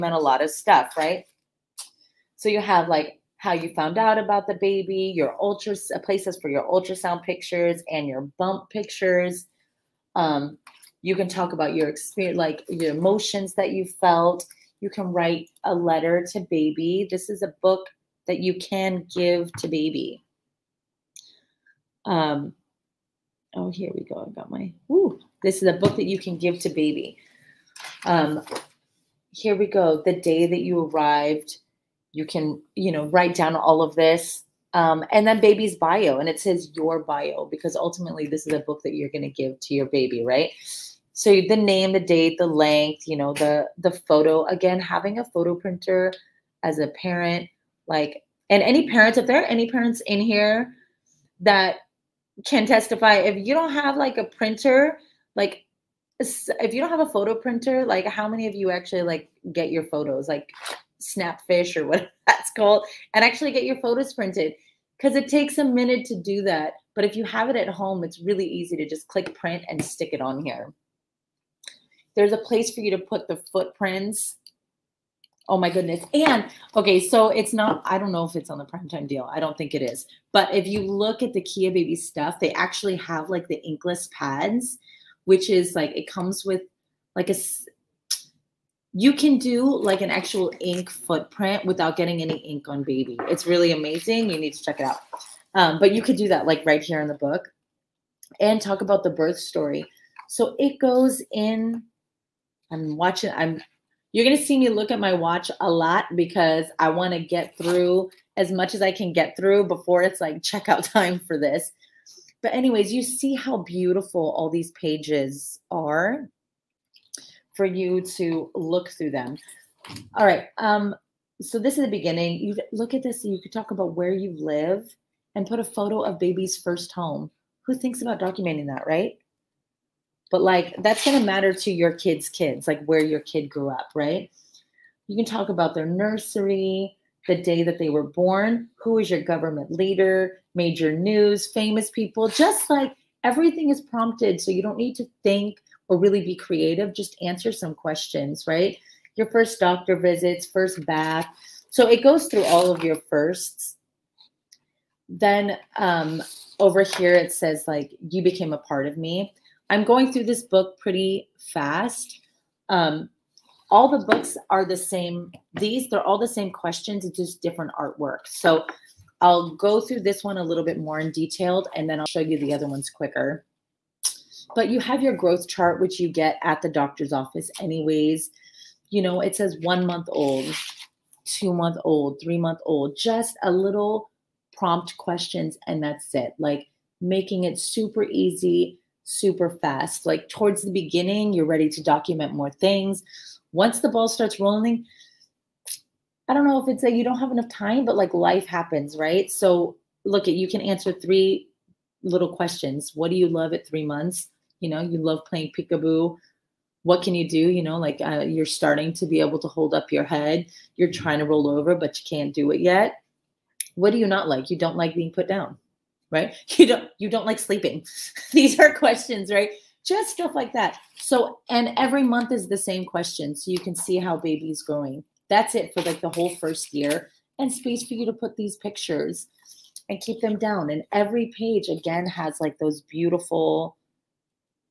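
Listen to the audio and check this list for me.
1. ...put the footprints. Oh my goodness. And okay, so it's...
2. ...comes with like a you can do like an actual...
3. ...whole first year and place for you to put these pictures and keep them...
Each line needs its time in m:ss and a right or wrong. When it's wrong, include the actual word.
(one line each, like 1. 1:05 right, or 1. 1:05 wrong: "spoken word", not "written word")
1. 1:12 right
2. 1:26 right
3. 3:46 wrong: "space", not "place".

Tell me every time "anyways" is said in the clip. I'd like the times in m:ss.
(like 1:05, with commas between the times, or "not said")
1:52, 2:57.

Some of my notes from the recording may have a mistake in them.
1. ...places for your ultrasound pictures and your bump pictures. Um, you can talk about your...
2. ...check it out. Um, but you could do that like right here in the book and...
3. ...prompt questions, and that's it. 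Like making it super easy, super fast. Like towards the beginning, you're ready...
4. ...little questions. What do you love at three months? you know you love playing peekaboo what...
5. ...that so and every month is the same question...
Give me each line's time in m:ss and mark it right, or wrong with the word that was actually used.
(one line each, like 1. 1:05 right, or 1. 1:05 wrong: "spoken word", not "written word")
1. 0:05 right
2. 1:34 right
3. 3:04 right
4. 3:22 right
5. 3:40 right.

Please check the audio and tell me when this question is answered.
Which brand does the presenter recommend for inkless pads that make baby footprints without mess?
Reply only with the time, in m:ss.
1:21.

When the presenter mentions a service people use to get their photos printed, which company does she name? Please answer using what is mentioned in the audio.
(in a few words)
Snapfish.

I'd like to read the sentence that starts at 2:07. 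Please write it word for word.
Who thinks about documenting that, right?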